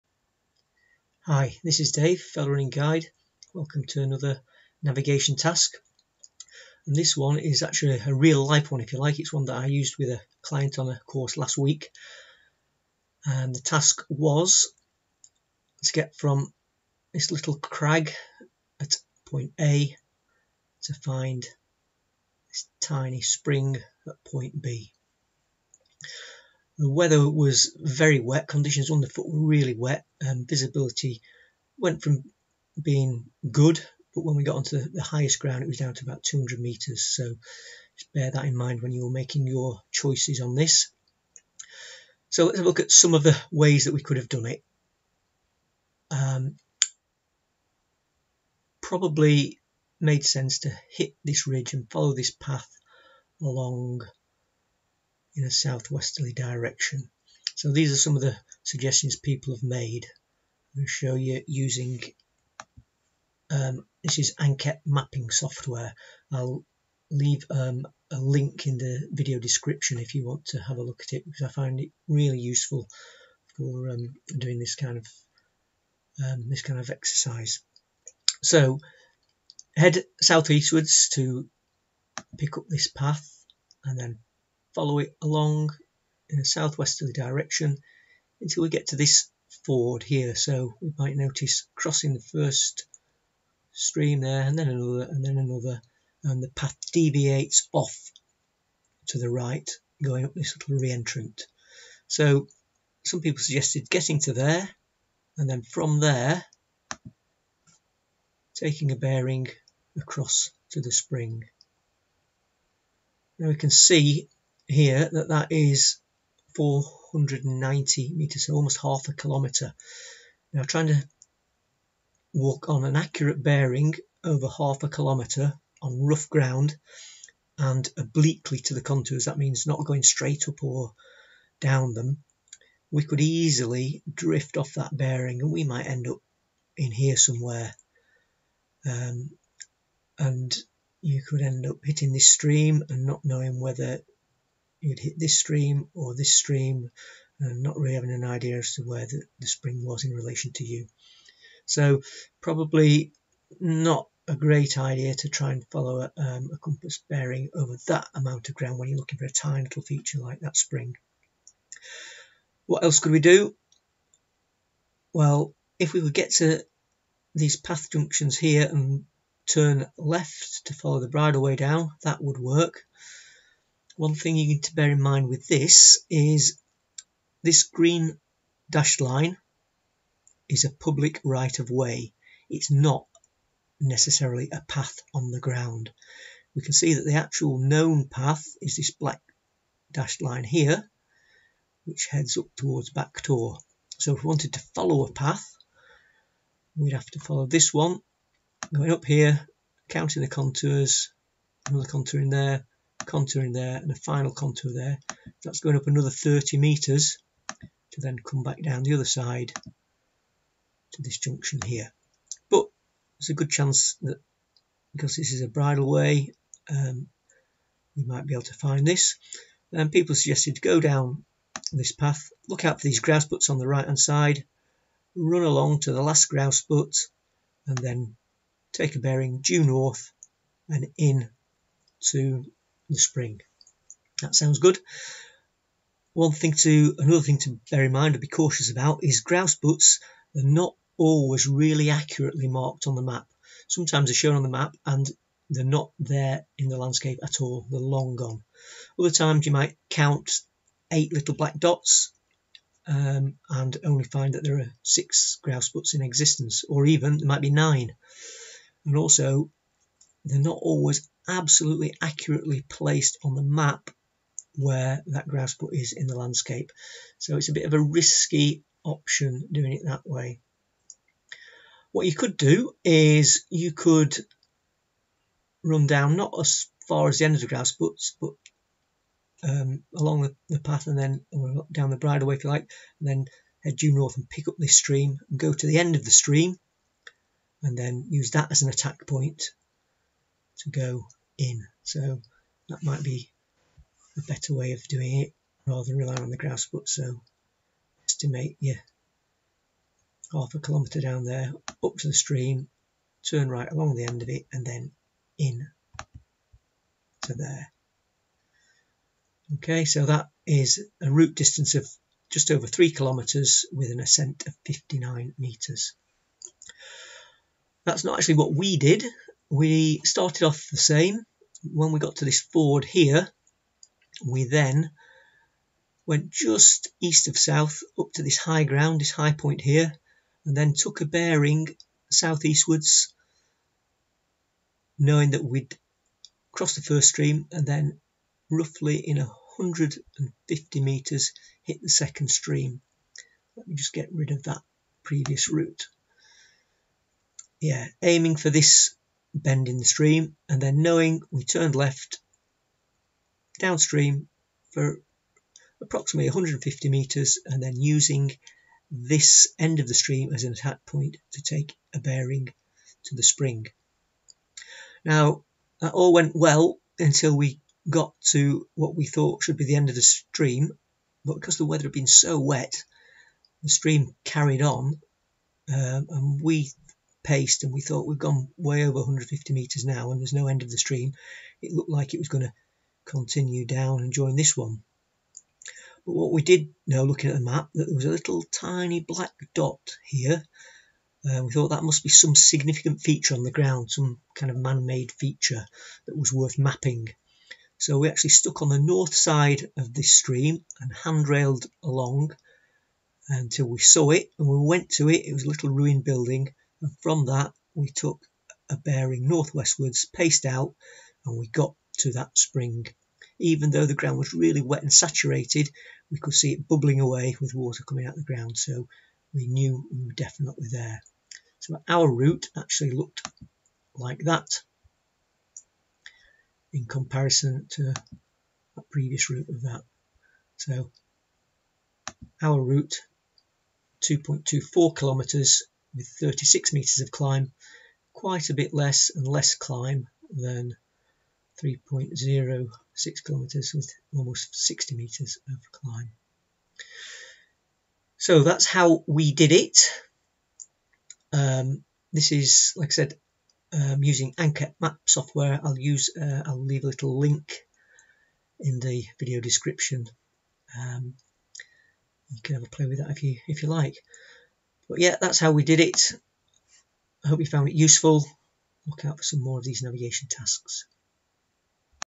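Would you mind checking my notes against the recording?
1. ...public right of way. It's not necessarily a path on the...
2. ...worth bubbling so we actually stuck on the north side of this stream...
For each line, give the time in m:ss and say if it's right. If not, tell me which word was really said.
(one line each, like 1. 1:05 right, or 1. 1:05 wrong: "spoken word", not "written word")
1. 3:00 right
2. 6:36 wrong: "mapping", not "bubbling".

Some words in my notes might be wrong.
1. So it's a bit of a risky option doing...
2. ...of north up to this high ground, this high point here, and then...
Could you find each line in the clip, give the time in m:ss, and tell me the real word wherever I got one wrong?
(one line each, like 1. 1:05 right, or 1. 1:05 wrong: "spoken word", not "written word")
1. 4:27 right
2. 5:27 wrong: "south", not "north".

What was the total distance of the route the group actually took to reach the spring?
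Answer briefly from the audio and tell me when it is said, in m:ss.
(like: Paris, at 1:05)
2.24 kilometres, at 7:14.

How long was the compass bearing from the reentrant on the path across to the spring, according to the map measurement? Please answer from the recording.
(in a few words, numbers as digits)
490 metres.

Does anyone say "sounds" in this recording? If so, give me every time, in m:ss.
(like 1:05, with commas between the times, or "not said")
3:54.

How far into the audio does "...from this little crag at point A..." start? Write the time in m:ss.
0:16.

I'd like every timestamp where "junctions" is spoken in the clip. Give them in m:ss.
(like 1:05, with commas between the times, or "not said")
2:47, 3:31.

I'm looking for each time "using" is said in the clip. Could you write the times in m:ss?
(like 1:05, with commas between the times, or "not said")
1:01, 5:57, 7:34.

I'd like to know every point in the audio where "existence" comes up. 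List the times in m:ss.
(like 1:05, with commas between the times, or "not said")
4:16.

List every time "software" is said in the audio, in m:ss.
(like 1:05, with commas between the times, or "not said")
1:05, 7:35.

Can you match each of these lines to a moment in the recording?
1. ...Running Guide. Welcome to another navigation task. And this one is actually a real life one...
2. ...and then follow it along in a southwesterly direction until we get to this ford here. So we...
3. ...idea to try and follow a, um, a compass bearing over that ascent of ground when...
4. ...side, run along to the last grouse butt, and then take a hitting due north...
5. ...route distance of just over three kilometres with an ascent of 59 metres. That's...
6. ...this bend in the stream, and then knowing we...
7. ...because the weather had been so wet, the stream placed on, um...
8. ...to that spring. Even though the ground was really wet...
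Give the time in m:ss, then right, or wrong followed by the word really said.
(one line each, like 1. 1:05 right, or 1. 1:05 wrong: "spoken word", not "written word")
1. 0:02 right
2. 1:23 right
3. 2:34 wrong: "amount", not "ascent"
4. 3:43 wrong: "bearing", not "hitting"
5. 5:11 right
6. 5:48 right
7. 6:11 wrong: "carried", not "placed"
8. 6:51 right.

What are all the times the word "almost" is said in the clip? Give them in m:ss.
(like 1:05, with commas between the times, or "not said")
1:58, 7:24.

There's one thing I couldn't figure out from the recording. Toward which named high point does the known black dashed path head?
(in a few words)
Back Tor.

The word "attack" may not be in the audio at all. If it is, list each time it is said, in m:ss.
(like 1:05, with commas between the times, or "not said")
4:48, 6:00.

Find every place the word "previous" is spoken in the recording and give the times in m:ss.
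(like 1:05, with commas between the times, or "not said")
5:45, 7:08.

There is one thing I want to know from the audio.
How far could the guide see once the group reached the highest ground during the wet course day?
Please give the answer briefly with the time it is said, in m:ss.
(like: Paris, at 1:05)
200 metres, at 0:36.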